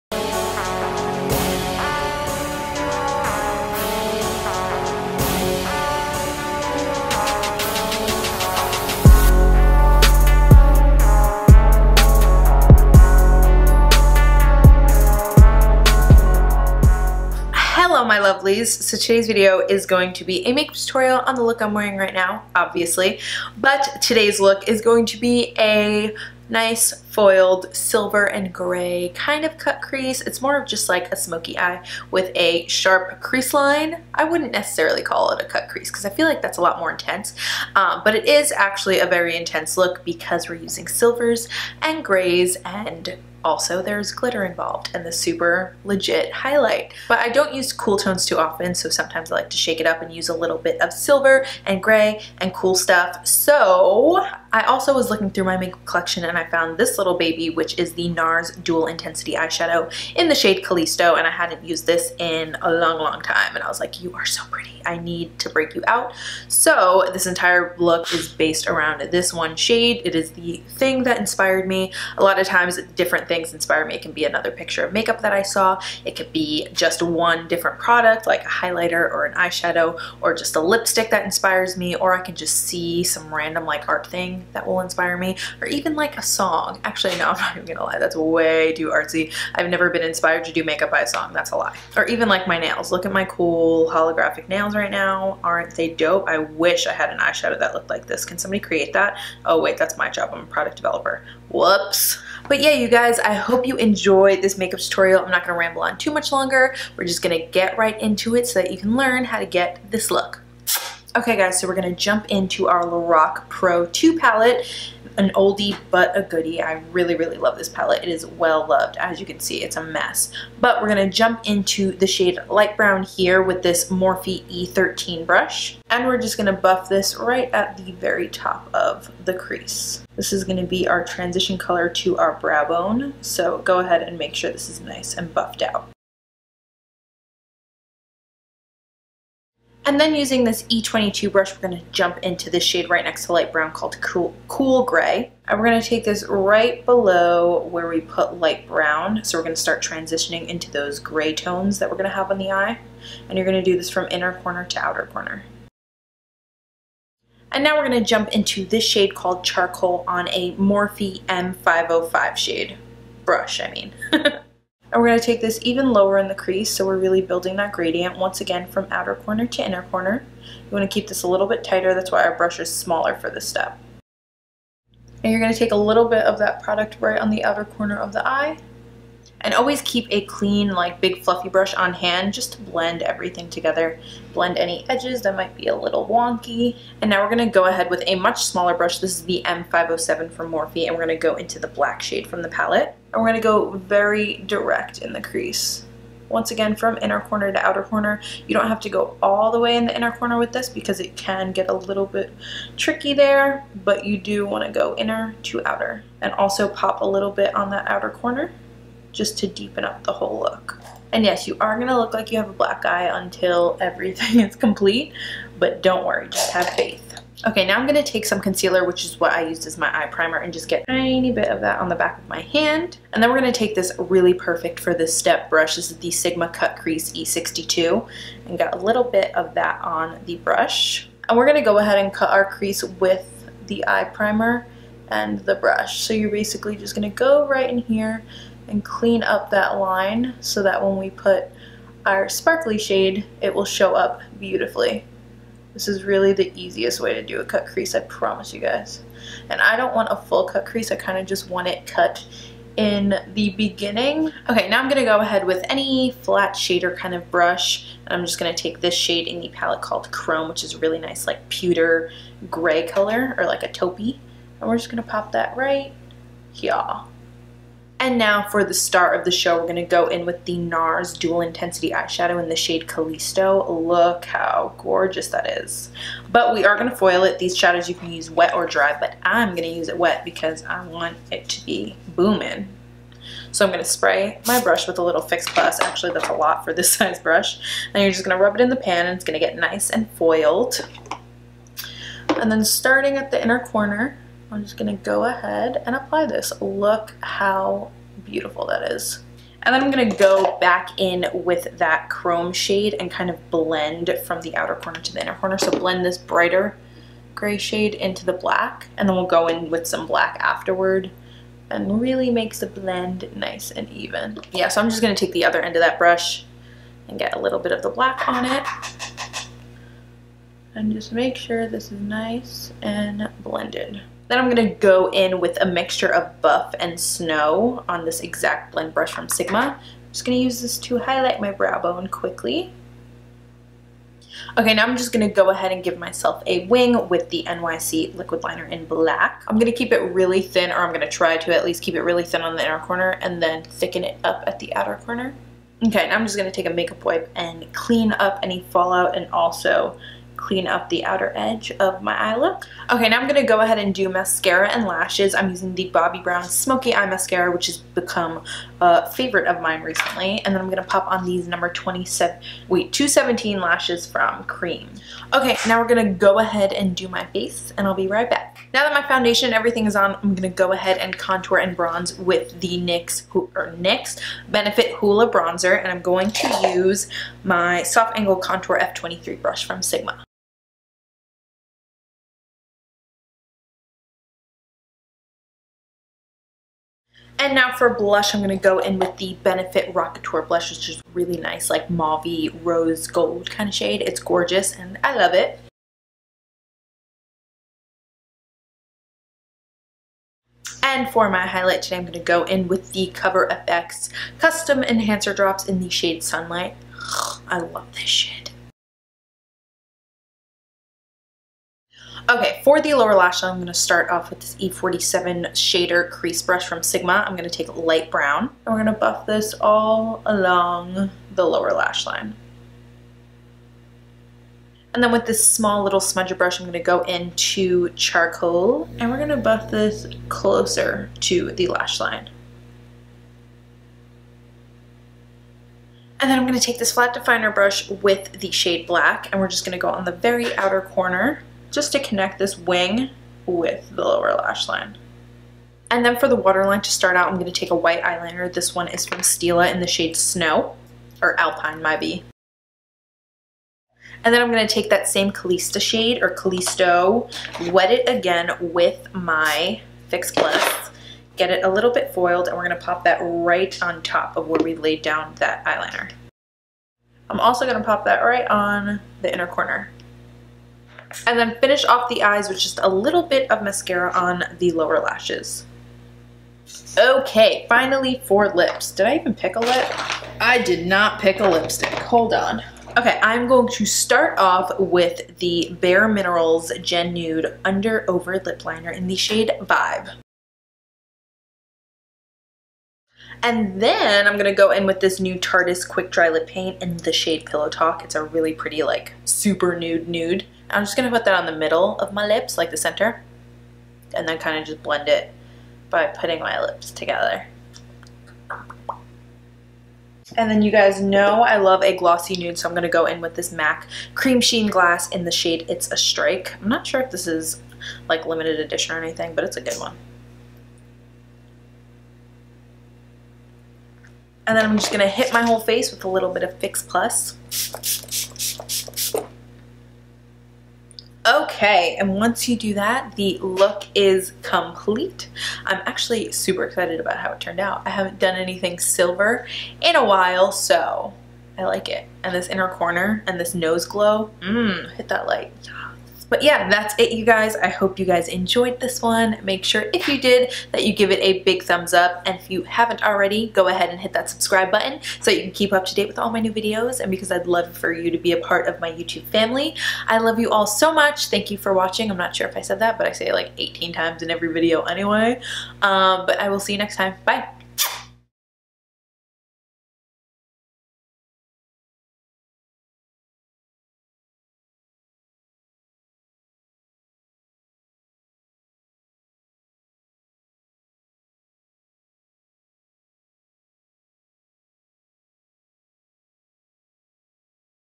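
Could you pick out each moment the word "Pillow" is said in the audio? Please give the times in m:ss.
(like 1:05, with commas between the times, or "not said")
8:17.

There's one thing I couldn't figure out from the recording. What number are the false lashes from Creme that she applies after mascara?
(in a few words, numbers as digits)
217.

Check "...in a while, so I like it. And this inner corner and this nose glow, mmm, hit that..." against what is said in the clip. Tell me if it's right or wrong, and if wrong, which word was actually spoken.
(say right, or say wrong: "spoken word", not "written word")
right.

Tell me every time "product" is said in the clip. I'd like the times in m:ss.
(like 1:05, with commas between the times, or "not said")
1:17, 1:40, 2:56.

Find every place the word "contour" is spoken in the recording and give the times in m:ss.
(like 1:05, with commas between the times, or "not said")
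6:11, 6:18.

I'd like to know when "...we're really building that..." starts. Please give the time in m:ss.
2:46.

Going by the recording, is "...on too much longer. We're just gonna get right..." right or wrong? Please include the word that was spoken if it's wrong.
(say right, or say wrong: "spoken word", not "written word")
right.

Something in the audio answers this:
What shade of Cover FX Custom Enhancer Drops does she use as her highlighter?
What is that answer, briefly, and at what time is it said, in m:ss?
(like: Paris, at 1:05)
Sunlight, at 6:46.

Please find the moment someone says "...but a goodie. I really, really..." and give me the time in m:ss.
1:55.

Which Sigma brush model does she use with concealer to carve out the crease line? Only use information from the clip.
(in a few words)
E62.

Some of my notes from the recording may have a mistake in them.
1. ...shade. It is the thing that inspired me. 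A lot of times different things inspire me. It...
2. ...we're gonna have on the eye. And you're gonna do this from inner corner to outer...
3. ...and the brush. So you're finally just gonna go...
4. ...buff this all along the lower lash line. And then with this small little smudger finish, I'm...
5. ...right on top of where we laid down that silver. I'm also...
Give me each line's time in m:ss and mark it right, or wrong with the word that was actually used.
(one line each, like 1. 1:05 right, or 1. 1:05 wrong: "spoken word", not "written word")
1. 1:09 right
2. 2:31 right
3. 3:55 wrong: "basically", not "finally"
4. 6:58 wrong: "brush", not "finish"
5. 7:43 wrong: "eyeliner", not "silver".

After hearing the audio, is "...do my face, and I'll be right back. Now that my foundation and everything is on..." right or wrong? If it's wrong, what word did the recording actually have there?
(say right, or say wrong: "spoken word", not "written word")
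right.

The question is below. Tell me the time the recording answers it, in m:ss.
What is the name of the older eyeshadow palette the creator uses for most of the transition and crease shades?
1:52.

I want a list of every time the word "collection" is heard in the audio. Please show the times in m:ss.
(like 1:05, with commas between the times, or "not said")
0:55.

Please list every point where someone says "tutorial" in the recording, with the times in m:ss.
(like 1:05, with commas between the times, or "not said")
0:20, 1:44.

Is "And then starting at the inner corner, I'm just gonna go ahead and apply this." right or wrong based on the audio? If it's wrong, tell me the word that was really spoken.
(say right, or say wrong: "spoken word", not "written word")
right.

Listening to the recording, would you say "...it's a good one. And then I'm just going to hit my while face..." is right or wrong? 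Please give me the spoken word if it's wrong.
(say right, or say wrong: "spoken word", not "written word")
wrong: "whole", not "while".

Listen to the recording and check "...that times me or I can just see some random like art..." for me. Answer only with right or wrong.
wrong.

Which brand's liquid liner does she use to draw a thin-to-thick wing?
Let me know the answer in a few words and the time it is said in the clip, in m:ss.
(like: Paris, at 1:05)
NYC, at 5:37.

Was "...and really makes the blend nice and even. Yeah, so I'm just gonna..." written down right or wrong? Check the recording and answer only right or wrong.
right.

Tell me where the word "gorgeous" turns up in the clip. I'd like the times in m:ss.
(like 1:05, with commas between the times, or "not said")
4:34, 6:34.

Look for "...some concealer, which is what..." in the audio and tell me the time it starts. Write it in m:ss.
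3:38.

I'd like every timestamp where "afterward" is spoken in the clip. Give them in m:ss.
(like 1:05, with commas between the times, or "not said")
5:10.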